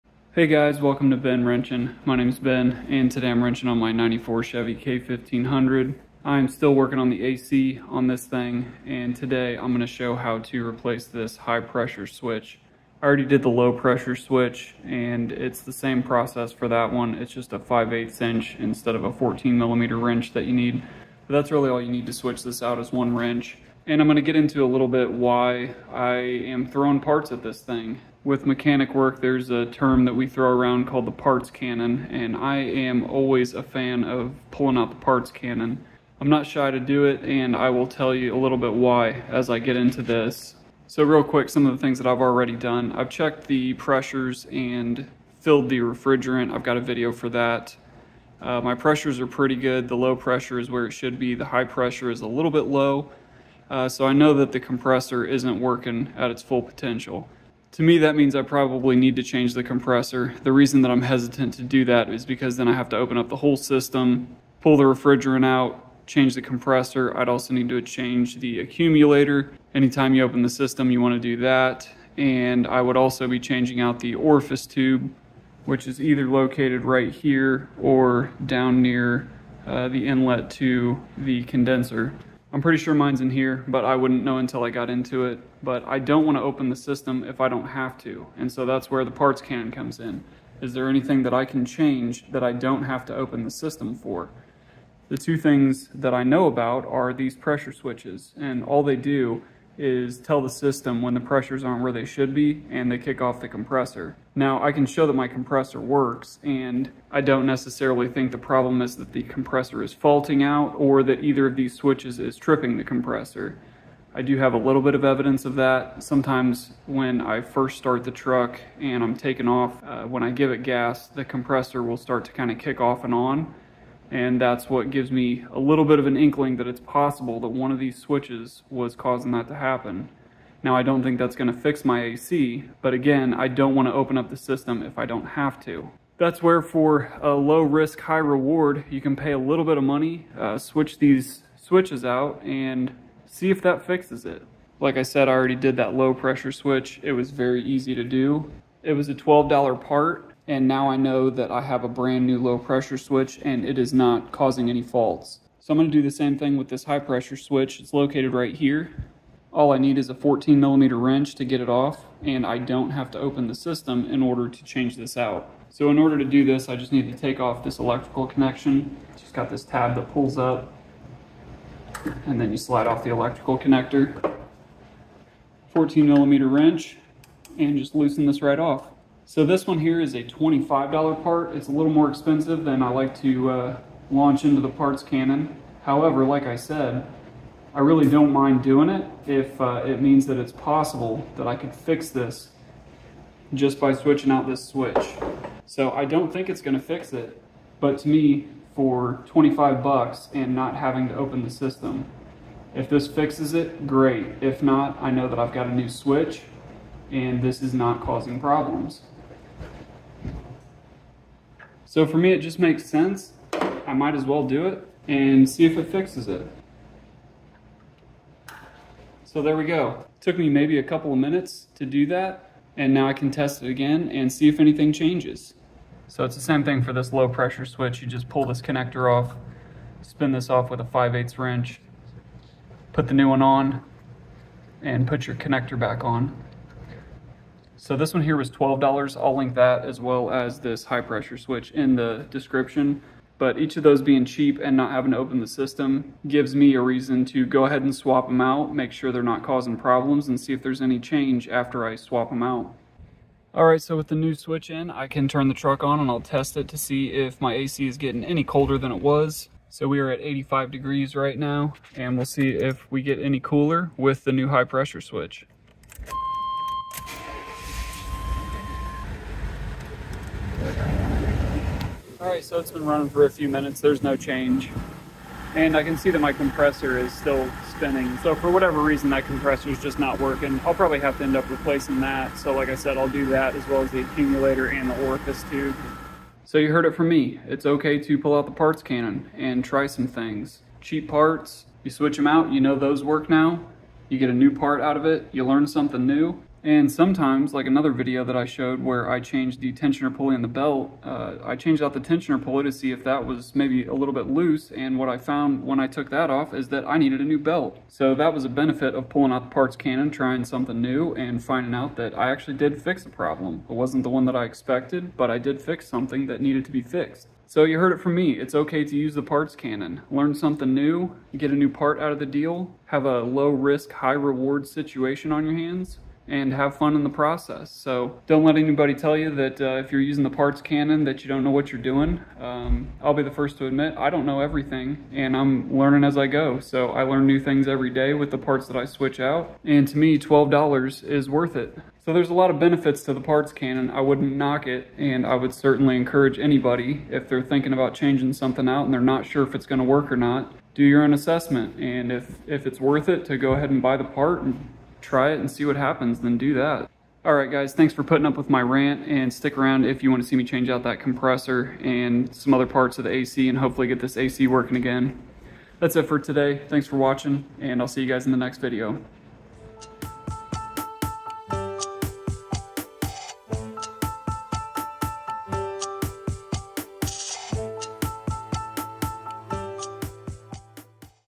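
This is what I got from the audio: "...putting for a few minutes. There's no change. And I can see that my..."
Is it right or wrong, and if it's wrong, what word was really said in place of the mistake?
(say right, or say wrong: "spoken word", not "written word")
wrong: "running", not "putting".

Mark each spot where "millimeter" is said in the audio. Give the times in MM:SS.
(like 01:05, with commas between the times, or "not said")
00:19, 02:40, 02:56.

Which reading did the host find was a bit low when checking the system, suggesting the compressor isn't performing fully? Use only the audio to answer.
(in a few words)
The high pressure.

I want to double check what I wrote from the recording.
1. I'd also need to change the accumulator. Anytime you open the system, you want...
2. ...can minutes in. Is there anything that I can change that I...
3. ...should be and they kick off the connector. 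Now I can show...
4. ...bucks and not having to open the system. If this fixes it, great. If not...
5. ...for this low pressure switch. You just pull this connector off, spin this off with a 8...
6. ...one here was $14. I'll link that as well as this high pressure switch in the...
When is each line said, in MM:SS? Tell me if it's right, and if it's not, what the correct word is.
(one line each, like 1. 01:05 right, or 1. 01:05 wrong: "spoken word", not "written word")
1. 01:07 right
2. 01:29 wrong: "comes", not "minutes"
3. 01:42 wrong: "compressor", not "connector"
4. 03:19 right
5. 03:46 wrong: "5", not "8"
6. 03:58 wrong: "12", not "14".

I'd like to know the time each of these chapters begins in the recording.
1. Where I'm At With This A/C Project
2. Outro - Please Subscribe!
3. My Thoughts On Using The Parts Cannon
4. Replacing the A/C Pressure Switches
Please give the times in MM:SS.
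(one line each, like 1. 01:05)
1. 00:40
2. 05:57
3. 04:46
4. 02:24.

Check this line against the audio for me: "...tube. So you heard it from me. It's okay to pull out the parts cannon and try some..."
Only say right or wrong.
right.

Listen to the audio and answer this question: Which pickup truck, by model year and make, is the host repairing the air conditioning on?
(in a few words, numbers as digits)
94 Chevy K1500.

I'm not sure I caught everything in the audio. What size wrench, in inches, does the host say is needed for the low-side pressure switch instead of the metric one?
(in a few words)
5/8 inch.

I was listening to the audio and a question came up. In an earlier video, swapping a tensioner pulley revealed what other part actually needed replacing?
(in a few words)
A new belt.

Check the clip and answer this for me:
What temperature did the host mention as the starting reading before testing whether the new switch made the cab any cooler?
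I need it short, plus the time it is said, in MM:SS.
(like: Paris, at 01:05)
85 degrees, at 04:20.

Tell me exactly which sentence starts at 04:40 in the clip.
I'll probably have to end up replacing that.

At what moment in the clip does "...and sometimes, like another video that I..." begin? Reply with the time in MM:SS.
04:56.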